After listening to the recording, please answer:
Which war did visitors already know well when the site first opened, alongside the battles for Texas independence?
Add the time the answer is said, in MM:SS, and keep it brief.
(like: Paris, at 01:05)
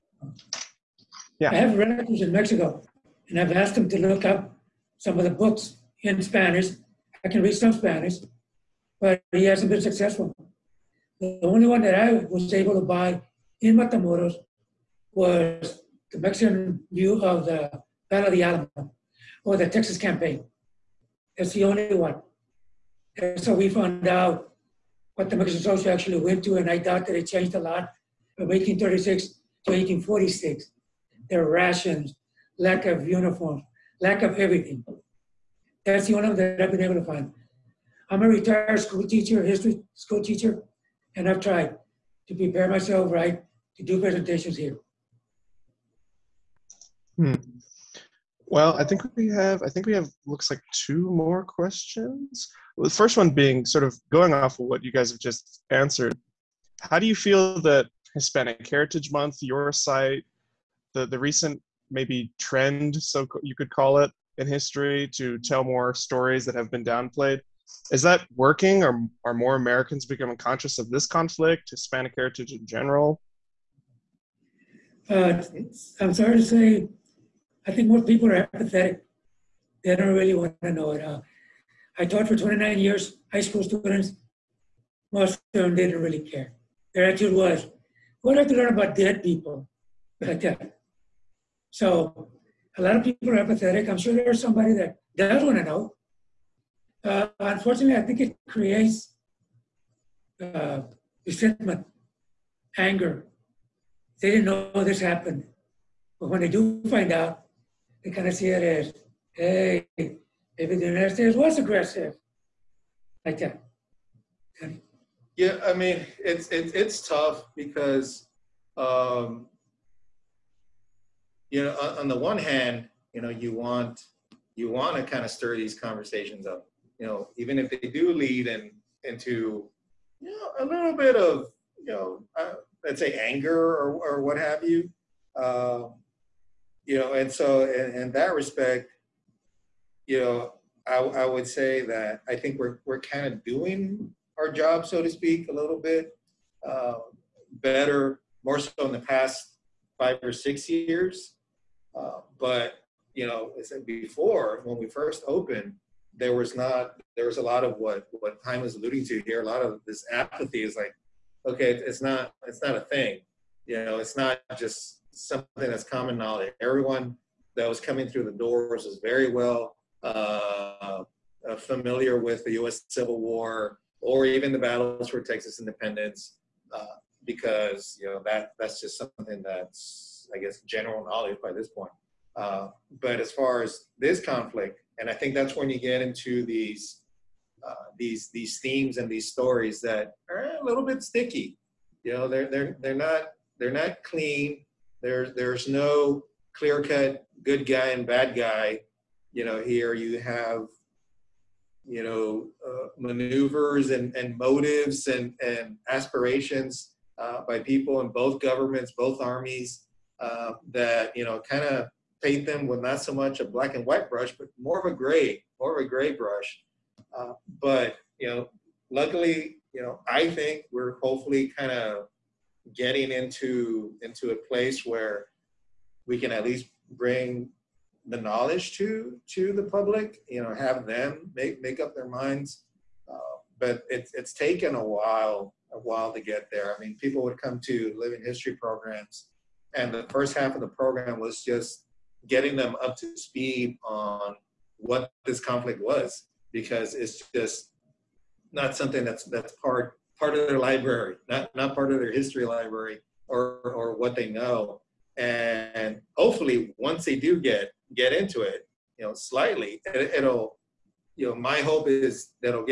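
U.S. Civil War, at 02:52.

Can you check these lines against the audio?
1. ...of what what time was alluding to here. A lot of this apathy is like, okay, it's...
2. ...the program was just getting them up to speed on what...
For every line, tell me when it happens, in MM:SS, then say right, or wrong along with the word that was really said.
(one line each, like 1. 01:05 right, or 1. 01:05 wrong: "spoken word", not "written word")
1. 02:37 right
2. 04:00 right.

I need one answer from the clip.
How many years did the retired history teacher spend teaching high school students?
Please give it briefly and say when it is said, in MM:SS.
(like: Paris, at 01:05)
29, at 01:22.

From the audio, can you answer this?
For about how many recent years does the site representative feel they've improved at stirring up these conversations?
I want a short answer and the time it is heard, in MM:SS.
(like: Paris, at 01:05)
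5 or 6, at 02:29.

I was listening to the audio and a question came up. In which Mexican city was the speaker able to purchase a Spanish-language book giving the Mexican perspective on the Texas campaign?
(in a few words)
Matamoros.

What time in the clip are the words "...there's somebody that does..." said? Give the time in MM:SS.
01:34.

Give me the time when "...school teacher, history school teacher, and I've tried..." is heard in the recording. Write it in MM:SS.
00:38.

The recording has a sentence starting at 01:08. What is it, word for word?
Or are more Americans becoming conscious of this conflict, Hispanic heritage in general?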